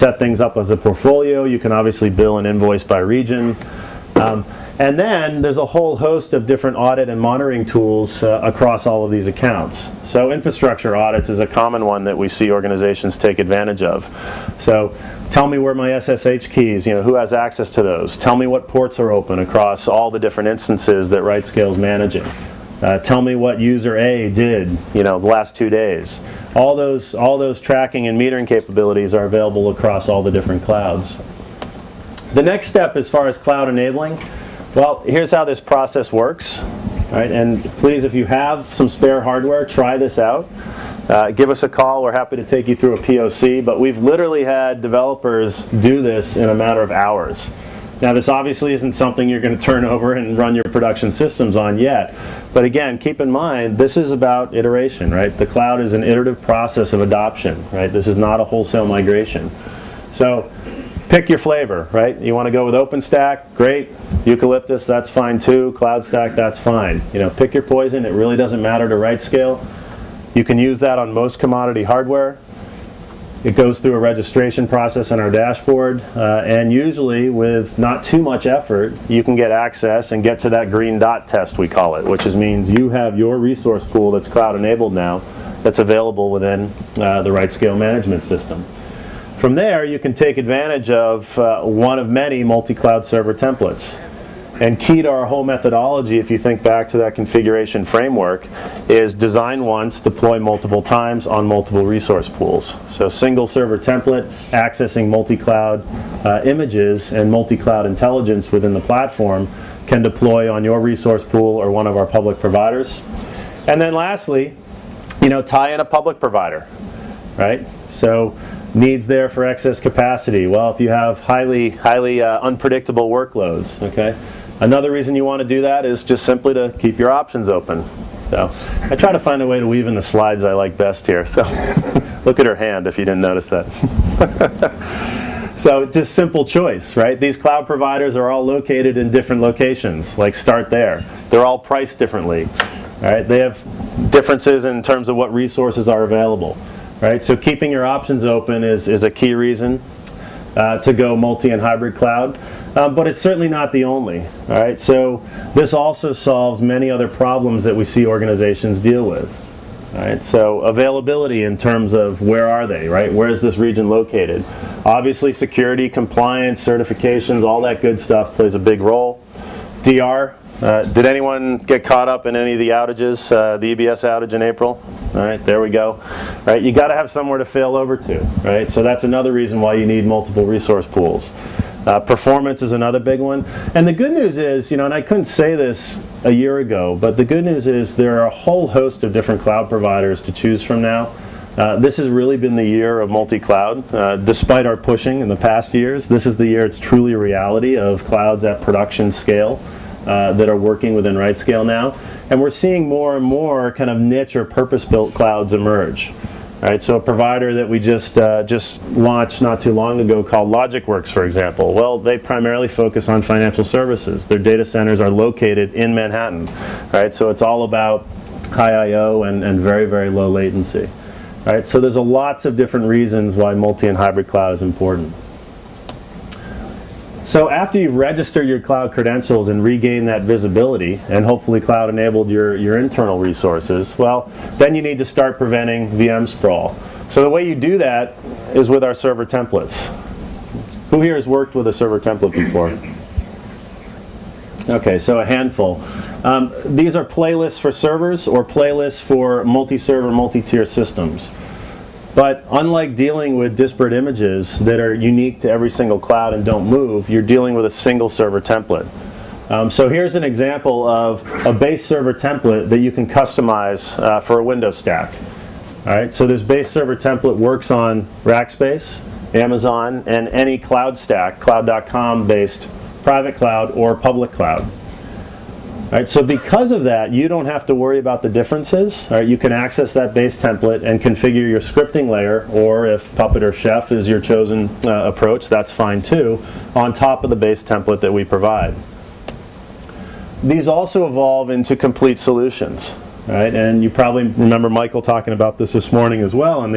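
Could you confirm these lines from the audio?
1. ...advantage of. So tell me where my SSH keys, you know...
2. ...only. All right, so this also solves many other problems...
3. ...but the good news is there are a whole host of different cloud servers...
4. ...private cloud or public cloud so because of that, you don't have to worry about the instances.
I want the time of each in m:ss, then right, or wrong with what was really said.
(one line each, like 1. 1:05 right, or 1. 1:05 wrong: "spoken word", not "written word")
1. 0:13 right
2. 2:33 right
3. 3:06 wrong: "providers", not "servers"
4. 4:33 wrong: "differences", not "instances".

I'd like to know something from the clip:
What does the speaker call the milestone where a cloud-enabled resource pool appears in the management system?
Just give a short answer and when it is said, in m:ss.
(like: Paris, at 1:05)
green dot test, at 1:20.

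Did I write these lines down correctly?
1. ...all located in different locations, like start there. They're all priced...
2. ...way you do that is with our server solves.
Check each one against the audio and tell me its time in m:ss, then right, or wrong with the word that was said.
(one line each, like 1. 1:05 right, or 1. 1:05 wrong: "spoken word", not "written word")
1. 2:18 right
2. 3:57 wrong: "templates", not "solves".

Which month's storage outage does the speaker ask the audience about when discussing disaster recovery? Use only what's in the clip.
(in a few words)
April.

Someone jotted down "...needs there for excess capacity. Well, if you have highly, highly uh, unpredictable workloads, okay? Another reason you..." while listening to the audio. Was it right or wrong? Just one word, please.
right.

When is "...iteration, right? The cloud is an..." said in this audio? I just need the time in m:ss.
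0:54.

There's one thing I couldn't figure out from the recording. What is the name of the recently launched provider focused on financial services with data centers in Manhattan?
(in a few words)
LogicWorks.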